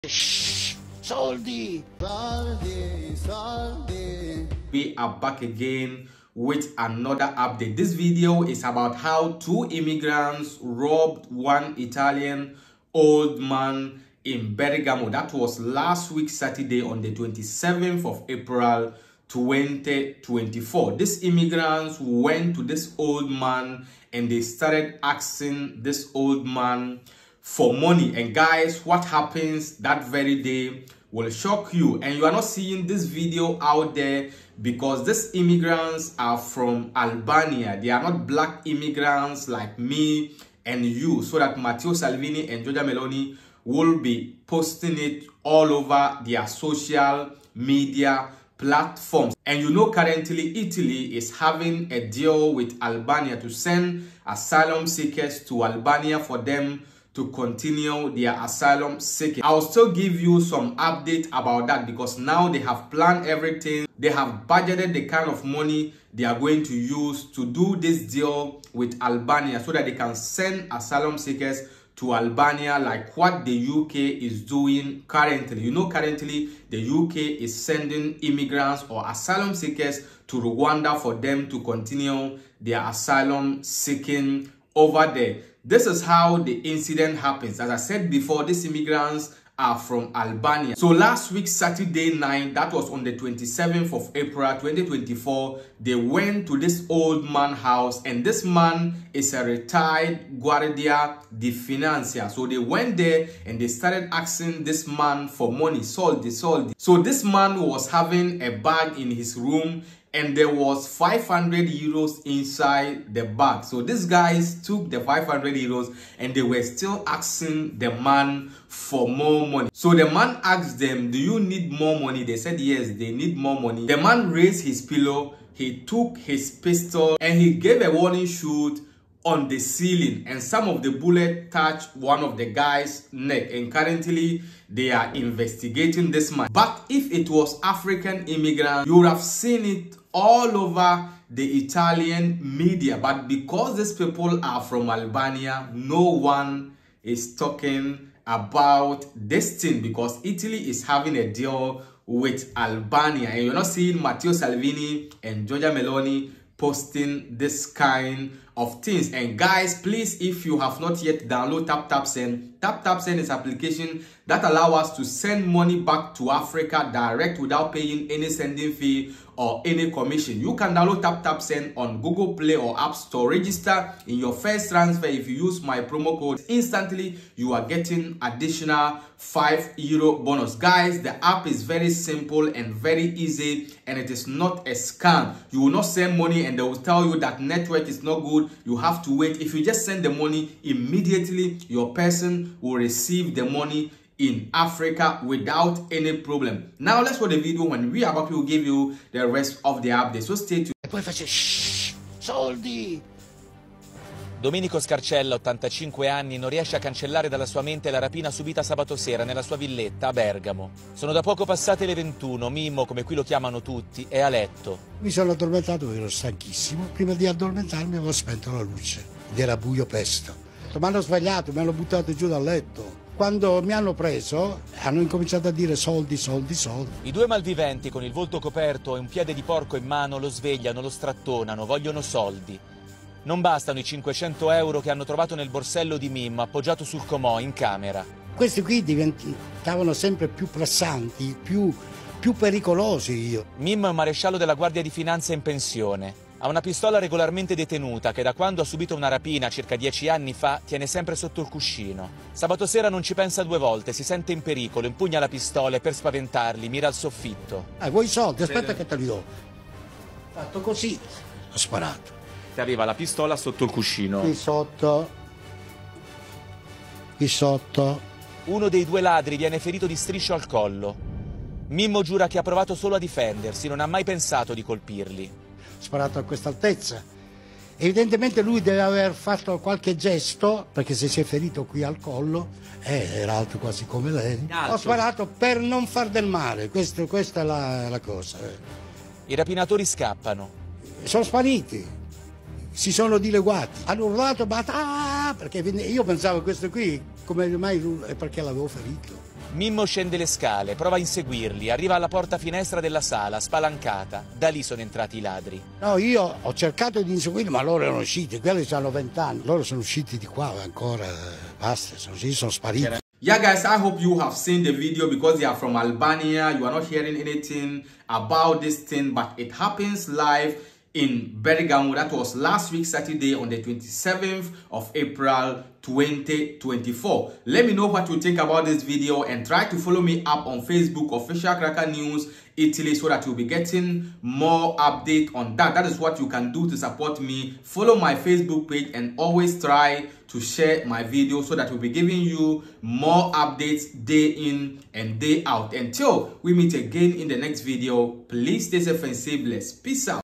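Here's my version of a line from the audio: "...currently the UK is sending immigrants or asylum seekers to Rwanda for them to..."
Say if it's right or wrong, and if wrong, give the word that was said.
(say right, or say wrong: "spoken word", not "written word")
right.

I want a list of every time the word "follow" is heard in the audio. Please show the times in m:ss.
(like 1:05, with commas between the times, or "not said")
5:29, 5:37.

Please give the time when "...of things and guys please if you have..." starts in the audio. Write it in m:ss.
2:38.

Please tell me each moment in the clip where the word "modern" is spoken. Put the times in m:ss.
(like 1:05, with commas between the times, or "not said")
not said.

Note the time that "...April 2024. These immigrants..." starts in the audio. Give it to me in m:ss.
0:18.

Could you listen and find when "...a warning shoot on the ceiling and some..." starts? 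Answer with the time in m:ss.
2:07.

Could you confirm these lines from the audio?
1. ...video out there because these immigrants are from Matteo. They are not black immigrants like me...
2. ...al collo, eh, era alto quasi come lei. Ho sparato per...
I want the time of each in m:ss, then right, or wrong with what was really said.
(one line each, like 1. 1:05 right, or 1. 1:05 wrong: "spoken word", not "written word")
1. 0:33 wrong: "Albania", not "Matteo"
2. 4:41 right.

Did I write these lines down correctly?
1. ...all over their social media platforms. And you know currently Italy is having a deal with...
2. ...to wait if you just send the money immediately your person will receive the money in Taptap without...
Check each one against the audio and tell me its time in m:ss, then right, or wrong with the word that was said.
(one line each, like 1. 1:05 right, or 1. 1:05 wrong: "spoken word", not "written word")
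1. 0:45 right
2. 3:09 wrong: "Africa", not "Taptap".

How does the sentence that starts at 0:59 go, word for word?
I'll still give you some update about that because now they have planned everything.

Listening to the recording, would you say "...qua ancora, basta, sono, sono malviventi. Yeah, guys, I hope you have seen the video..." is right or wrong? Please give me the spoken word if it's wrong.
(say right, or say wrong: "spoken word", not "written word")
wrong: "spariti", not "malviventi".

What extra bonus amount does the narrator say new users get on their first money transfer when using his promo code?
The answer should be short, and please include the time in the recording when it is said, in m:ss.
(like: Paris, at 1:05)
5 euros, at 2:59.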